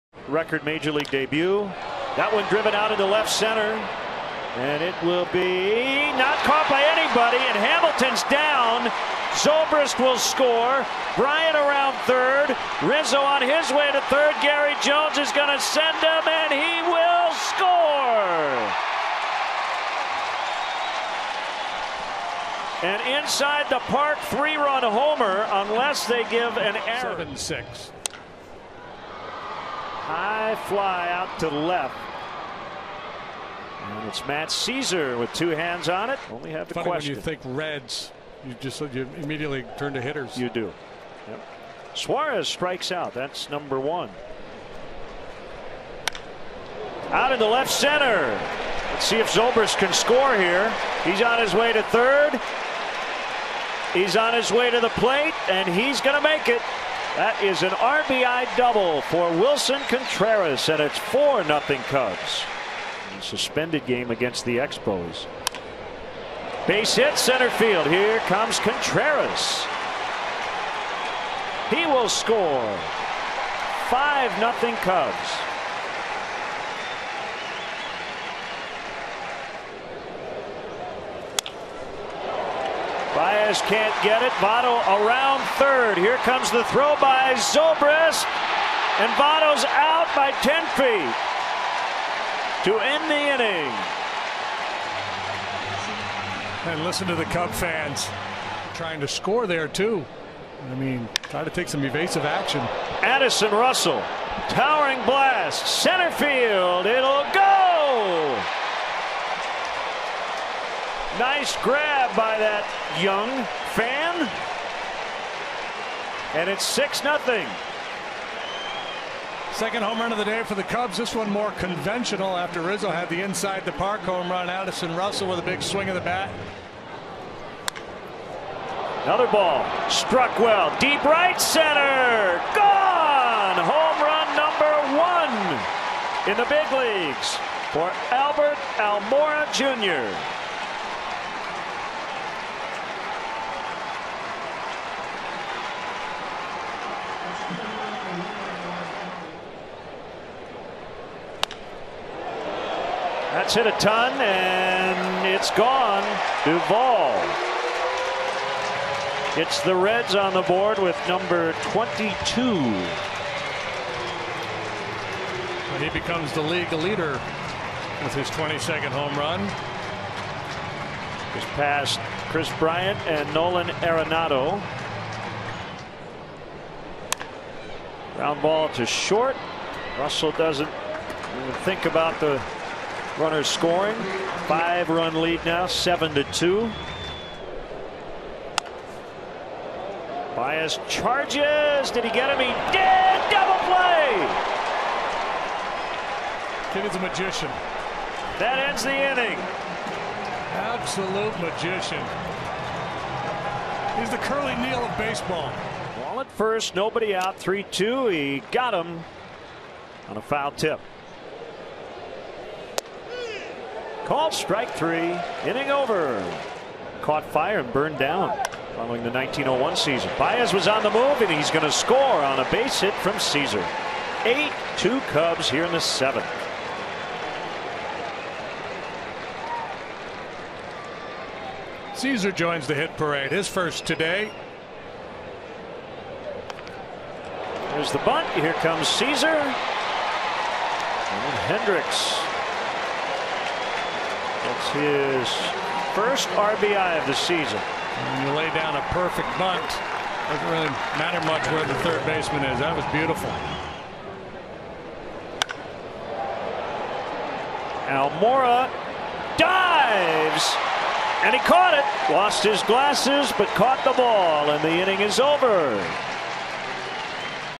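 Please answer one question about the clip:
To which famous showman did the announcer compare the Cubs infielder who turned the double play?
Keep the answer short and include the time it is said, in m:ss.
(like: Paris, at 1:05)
Curly Neal, at 3:24.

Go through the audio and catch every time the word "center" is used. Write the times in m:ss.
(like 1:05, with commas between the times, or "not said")
0:03, 0:47, 1:07, 1:45, 2:11.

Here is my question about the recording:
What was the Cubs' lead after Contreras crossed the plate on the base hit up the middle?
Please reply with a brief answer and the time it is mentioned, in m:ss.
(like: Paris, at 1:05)
5-0, at 1:13.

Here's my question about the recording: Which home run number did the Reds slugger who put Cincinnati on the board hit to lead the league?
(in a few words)
22.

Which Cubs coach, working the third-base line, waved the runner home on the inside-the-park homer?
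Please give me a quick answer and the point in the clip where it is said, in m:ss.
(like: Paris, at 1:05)
Gary Jones, at 0:14.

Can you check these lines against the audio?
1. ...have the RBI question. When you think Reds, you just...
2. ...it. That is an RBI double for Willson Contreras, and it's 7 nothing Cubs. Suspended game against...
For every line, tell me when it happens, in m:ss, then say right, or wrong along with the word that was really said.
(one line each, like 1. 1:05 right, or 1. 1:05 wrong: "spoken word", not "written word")
1. 0:36 wrong: "Funny", not "RBI"
2. 0:56 wrong: "4", not "7".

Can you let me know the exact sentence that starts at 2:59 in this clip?
Russell doesn't think about the Runners scoring.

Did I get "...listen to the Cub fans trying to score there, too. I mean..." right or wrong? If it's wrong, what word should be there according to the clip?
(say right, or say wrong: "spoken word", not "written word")
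right.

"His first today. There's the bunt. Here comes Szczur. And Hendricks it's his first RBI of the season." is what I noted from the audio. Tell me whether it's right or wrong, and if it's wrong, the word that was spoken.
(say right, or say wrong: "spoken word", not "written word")
right.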